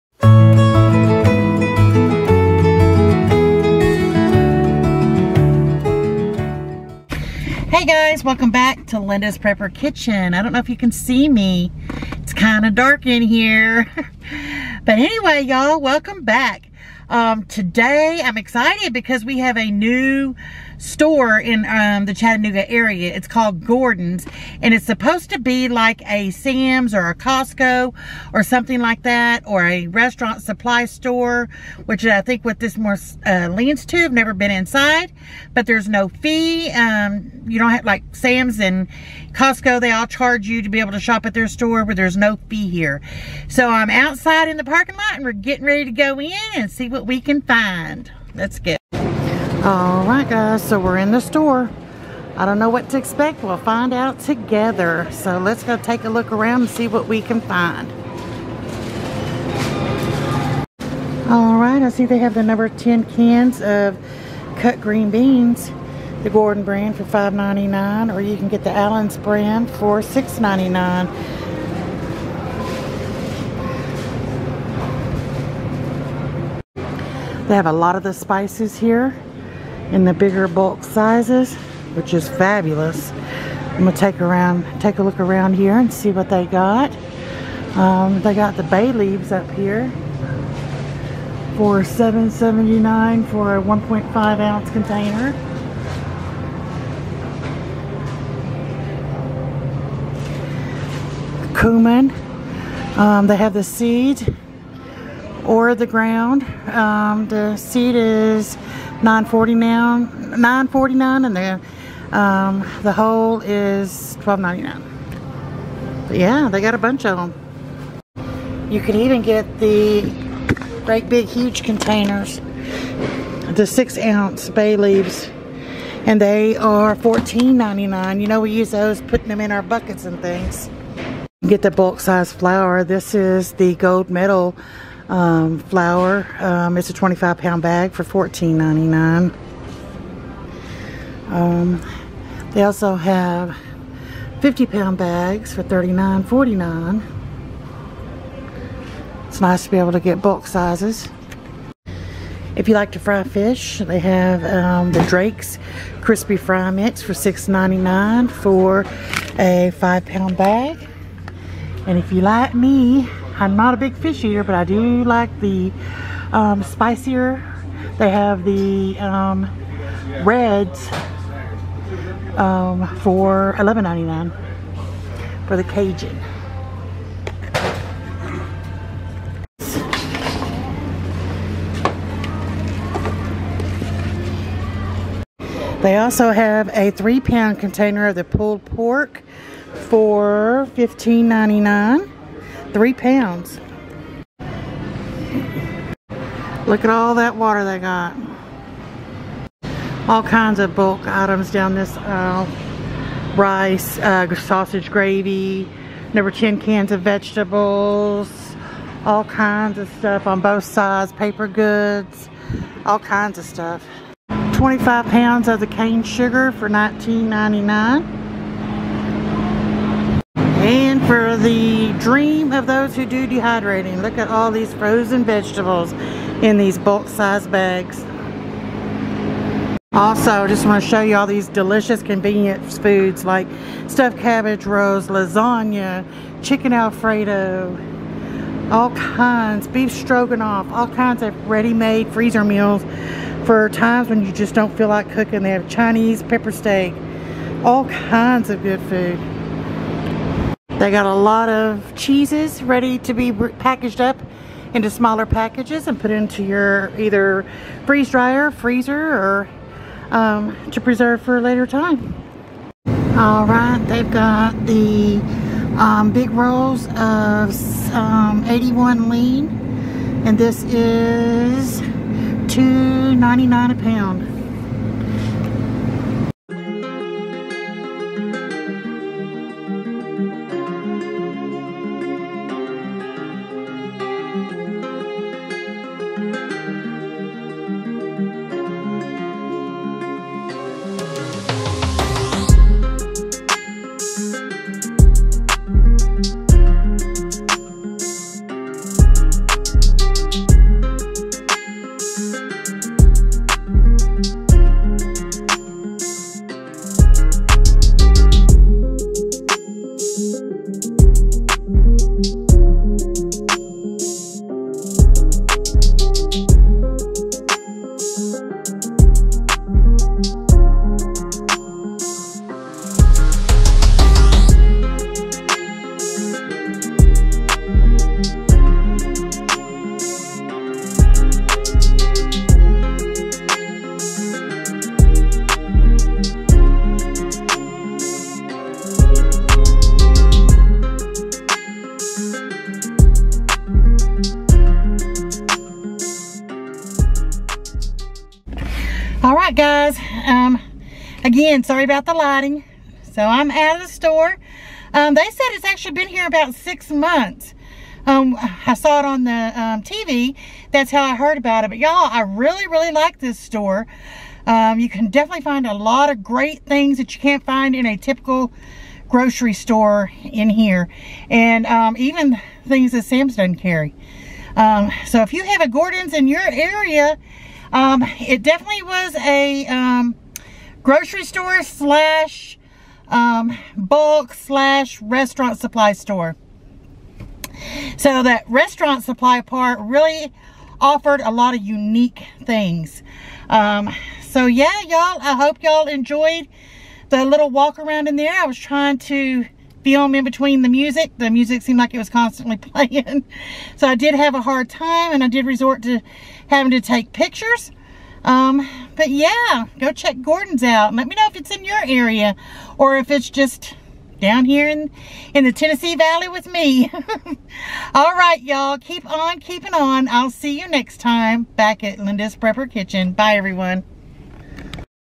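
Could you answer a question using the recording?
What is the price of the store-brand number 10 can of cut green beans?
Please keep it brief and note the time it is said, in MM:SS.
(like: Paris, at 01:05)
$5.99, at 01:07.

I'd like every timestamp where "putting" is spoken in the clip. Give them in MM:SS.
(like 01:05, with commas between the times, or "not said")
02:09.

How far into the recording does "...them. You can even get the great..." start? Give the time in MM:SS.
01:57.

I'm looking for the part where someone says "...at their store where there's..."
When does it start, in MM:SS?
00:41.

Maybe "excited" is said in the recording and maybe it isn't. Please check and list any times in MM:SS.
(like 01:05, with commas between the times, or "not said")
00:18.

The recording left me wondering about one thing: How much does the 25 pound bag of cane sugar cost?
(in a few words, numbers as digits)
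$19.99.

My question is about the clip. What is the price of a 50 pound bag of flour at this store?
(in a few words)
$39.49.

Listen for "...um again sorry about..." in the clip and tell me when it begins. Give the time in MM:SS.
05:50.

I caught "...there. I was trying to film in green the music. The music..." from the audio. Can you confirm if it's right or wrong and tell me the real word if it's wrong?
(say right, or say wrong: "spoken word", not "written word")
wrong: "between", not "green".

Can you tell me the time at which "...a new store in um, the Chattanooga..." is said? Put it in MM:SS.
00:19.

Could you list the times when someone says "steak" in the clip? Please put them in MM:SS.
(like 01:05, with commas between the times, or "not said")
04:06.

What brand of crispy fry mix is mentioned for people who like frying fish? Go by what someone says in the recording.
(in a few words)
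Drake's.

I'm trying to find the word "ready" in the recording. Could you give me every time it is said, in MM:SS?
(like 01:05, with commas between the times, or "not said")
00:45, 04:01, 04:12.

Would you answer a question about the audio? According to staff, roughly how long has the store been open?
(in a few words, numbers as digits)
About six months.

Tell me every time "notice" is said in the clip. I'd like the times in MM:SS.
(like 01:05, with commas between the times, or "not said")
not said.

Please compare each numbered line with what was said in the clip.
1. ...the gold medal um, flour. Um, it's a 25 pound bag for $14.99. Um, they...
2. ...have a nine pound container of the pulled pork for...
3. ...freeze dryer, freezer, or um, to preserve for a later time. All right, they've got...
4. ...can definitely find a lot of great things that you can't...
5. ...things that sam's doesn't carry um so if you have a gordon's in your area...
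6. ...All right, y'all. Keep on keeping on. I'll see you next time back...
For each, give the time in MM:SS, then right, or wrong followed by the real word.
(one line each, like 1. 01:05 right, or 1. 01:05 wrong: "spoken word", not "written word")
1. 02:13 right
2. 03:06 wrong: "three", not "nine"
3. 04:17 right
4. 06:04 right
5. 06:12 right
6. 06:57 right.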